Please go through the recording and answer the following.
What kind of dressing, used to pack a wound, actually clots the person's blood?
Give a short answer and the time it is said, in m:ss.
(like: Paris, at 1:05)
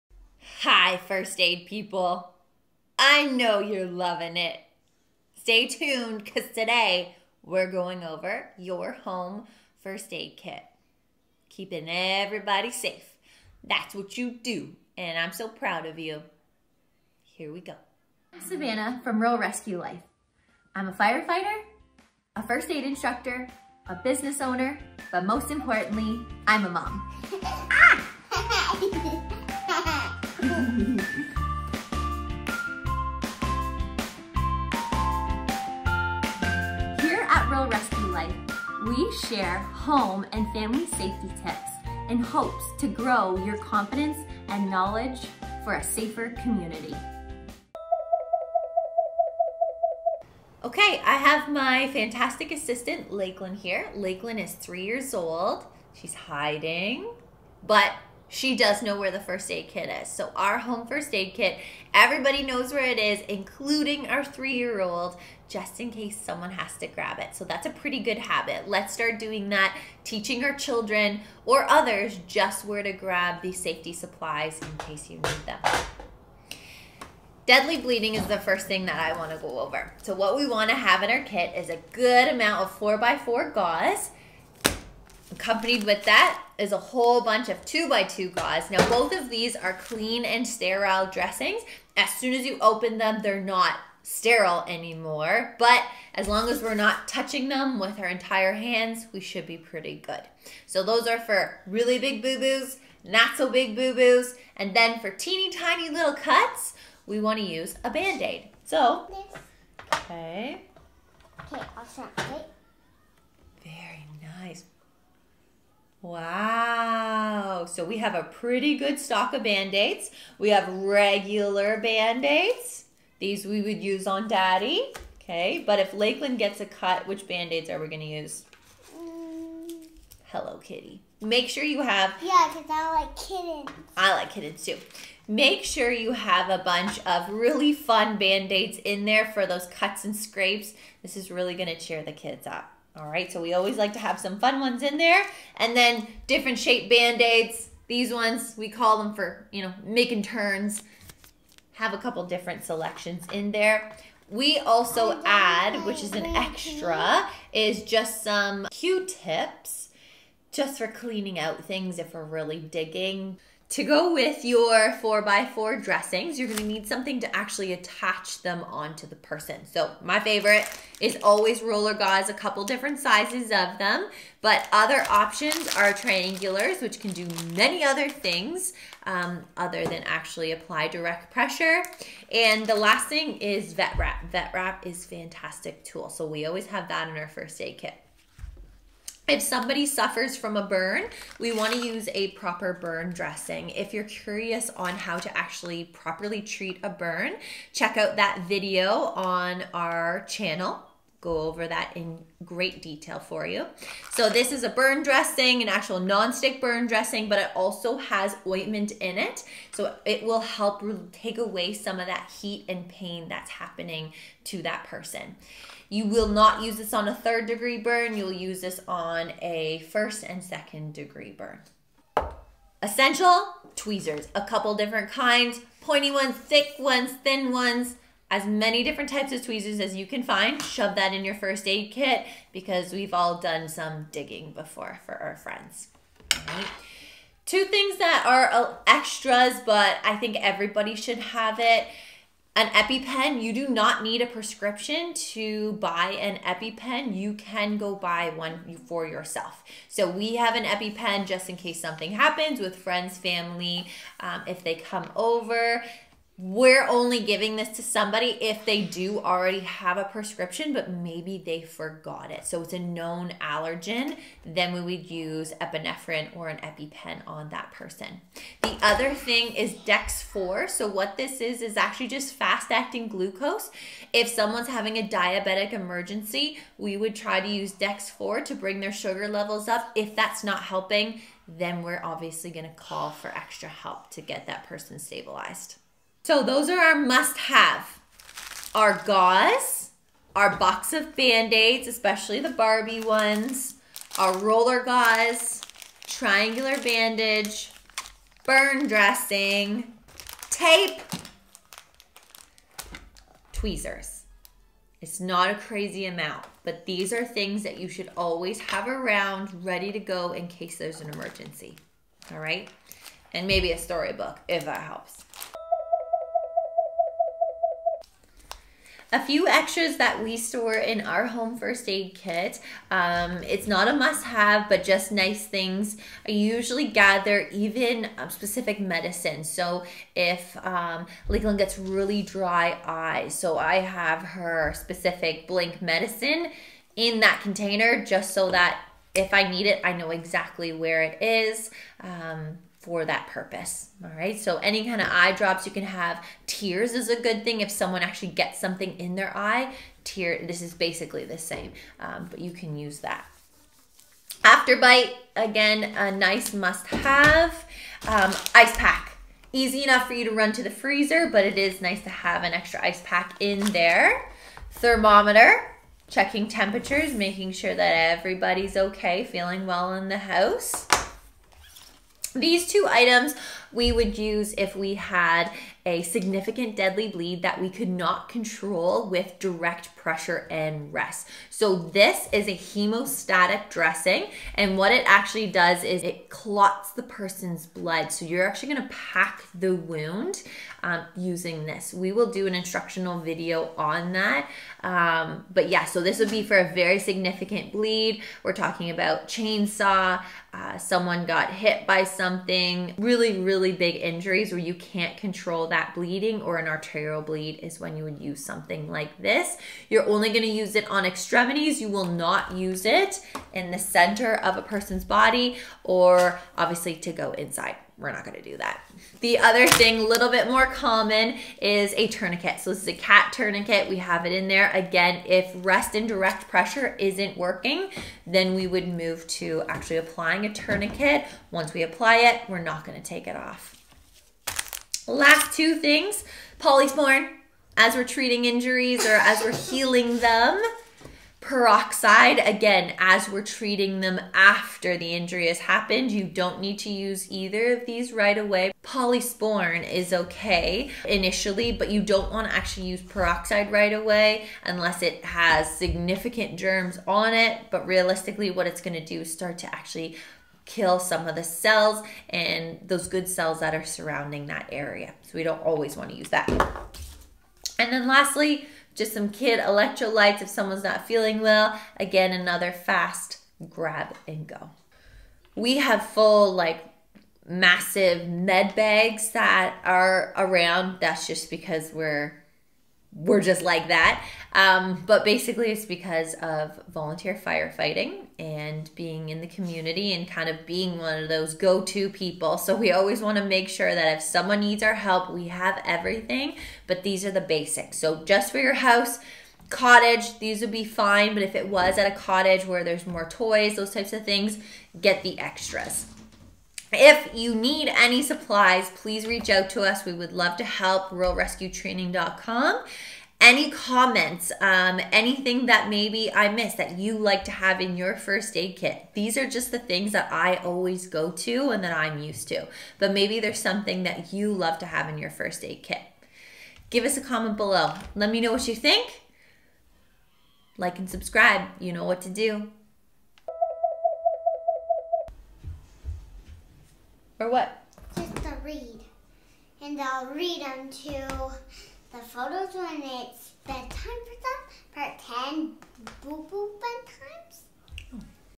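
Hemostatic dressing, at 6:22.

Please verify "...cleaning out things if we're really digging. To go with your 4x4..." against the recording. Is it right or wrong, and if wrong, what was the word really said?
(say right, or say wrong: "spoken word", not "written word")
right.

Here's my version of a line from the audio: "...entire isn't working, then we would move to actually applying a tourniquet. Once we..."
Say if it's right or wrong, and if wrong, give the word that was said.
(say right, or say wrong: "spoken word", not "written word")
wrong: "pressure", not "entire".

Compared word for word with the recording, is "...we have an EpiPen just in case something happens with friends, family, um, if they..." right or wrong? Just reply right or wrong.
right.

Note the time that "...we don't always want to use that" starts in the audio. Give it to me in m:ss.
7:45.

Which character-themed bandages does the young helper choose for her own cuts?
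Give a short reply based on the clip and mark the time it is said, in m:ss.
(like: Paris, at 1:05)
Hello Kitty, at 2:10.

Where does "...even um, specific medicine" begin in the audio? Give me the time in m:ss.
5:27.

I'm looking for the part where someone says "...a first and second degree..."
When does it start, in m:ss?
3:39.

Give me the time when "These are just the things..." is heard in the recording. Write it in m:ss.
8:39.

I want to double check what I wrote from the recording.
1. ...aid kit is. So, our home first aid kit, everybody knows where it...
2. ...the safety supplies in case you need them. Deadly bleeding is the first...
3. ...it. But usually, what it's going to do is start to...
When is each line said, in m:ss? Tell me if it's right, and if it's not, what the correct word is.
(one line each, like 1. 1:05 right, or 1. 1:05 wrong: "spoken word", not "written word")
1. 0:59 right
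2. 1:13 right
3. 7:37 wrong: "realistically", not "usually".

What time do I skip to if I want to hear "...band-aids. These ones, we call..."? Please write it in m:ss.
2:26.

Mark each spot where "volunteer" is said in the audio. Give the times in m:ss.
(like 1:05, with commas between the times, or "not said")
8:06.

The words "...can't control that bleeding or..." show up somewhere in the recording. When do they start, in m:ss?
6:44.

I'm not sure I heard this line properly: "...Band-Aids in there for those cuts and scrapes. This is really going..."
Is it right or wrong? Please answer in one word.
right.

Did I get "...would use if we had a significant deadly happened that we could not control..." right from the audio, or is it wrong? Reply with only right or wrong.
wrong.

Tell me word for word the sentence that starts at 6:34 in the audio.
Um, but yeah, so this would be for a very significant bleed.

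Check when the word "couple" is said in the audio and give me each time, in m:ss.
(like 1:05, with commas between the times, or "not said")
2:31, 2:52, 3:44.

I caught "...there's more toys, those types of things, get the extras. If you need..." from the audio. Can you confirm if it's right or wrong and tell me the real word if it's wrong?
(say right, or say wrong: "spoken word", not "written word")
right.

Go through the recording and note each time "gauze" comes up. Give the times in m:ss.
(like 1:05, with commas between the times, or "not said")
1:23, 1:28, 2:51, 4:49, 4:54.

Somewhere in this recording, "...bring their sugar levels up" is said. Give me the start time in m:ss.
4:38.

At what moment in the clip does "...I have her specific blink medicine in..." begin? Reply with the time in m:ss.
5:33.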